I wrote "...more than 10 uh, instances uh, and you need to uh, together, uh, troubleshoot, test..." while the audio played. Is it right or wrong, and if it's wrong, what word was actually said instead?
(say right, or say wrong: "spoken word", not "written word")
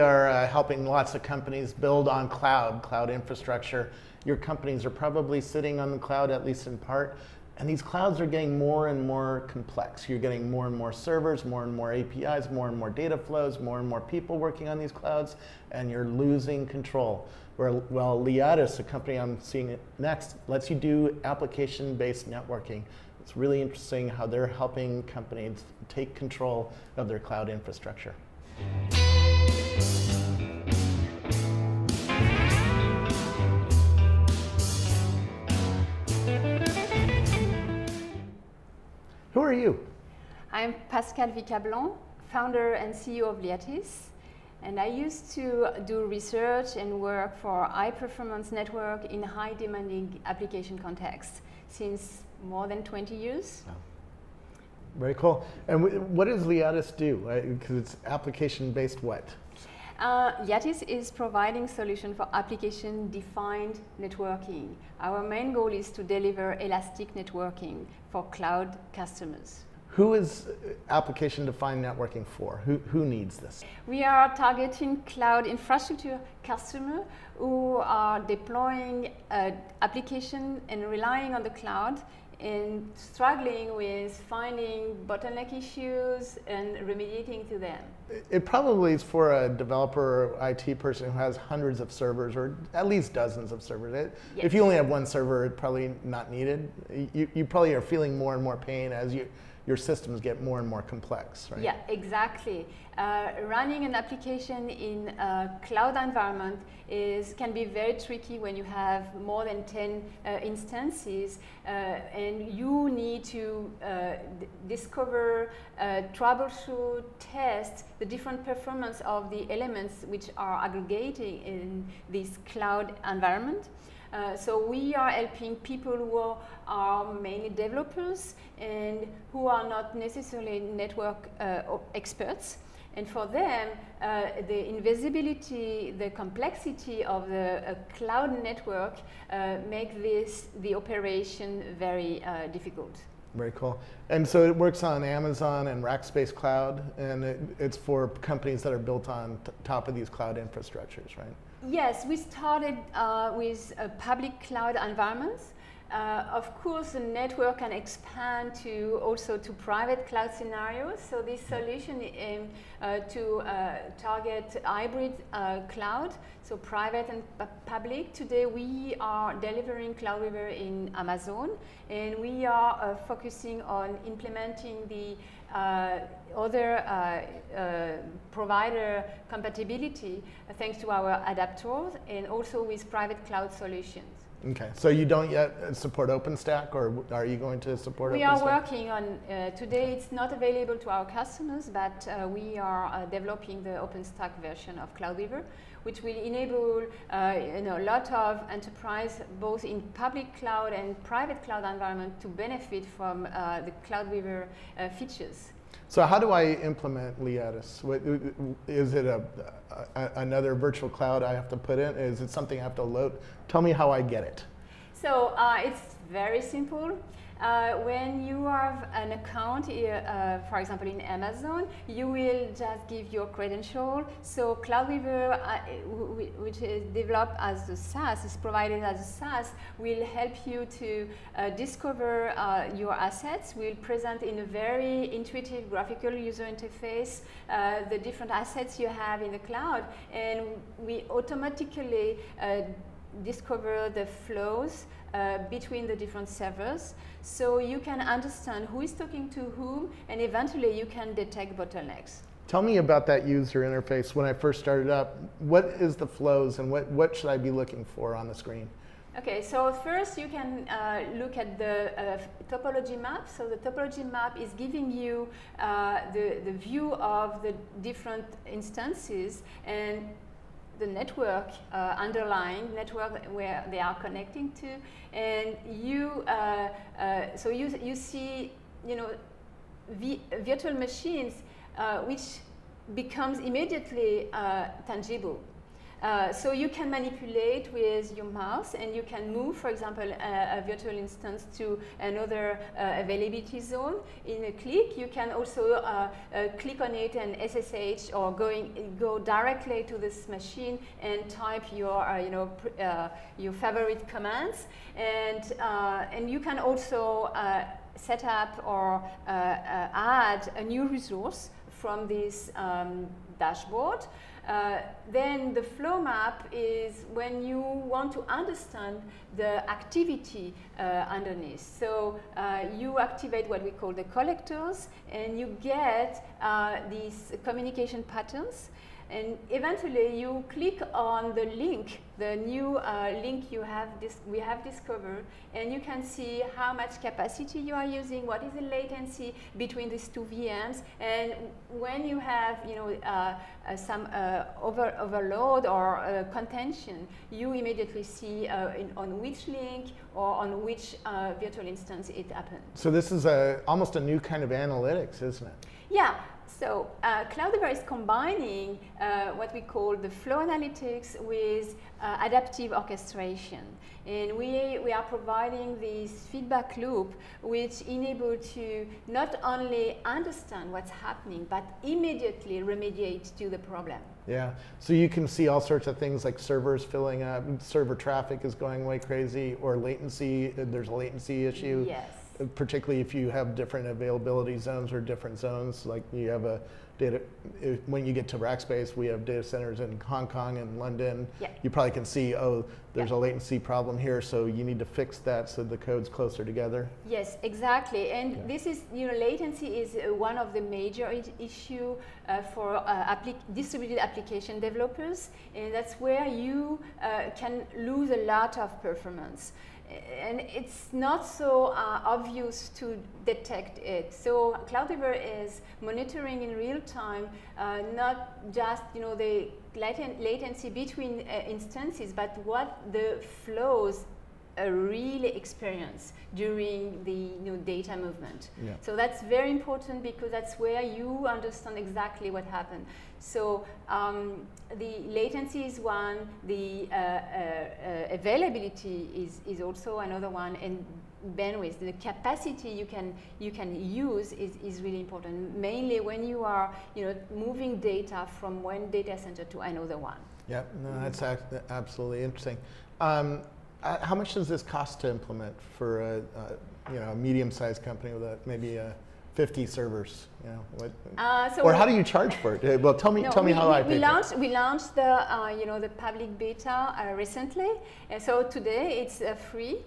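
wrong: "discover", not "together".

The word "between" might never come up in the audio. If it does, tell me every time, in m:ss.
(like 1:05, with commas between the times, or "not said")
4:05, 5:39, 7:00.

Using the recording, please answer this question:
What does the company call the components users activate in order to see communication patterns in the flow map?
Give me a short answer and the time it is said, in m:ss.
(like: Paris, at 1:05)
collectors, at 5:24.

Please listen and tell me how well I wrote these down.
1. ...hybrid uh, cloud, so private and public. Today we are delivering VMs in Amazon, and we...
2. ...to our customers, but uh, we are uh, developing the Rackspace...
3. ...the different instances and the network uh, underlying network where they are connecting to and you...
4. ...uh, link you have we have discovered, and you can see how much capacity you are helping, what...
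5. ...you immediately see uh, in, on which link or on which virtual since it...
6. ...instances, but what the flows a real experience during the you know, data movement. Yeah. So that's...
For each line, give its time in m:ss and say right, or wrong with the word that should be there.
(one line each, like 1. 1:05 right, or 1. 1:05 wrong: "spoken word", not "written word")
1. 2:44 wrong: "CloudWeaver", not "VMs"
2. 3:10 wrong: "OpenStack", not "Rackspace"
3. 4:27 right
4. 5:32 wrong: "using", not "helping"
5. 5:47 wrong: "instance", not "since"
6. 7:01 right.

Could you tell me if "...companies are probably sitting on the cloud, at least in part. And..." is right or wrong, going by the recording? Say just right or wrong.
right.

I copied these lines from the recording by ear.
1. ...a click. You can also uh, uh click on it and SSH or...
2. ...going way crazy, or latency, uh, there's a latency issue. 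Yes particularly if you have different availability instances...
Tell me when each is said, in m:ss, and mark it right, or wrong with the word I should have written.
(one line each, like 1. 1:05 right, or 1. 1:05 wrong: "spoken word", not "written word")
1. 4:54 right
2. 6:18 wrong: "zones", not "instances".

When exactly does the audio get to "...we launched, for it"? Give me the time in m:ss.
7:43.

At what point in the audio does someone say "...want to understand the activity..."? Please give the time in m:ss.
5:17.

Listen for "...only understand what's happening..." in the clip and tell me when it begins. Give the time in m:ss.
6:09.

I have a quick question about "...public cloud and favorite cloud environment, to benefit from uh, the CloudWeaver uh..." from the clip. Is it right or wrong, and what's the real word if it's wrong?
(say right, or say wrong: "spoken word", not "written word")
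wrong: "private", not "favorite".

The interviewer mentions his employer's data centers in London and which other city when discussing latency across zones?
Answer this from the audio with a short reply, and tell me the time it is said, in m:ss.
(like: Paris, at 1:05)
Hong Kong, at 6:30.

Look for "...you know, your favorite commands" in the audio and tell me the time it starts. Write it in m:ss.
5:02.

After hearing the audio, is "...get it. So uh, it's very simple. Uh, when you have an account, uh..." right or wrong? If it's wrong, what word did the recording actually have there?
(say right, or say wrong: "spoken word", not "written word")
right.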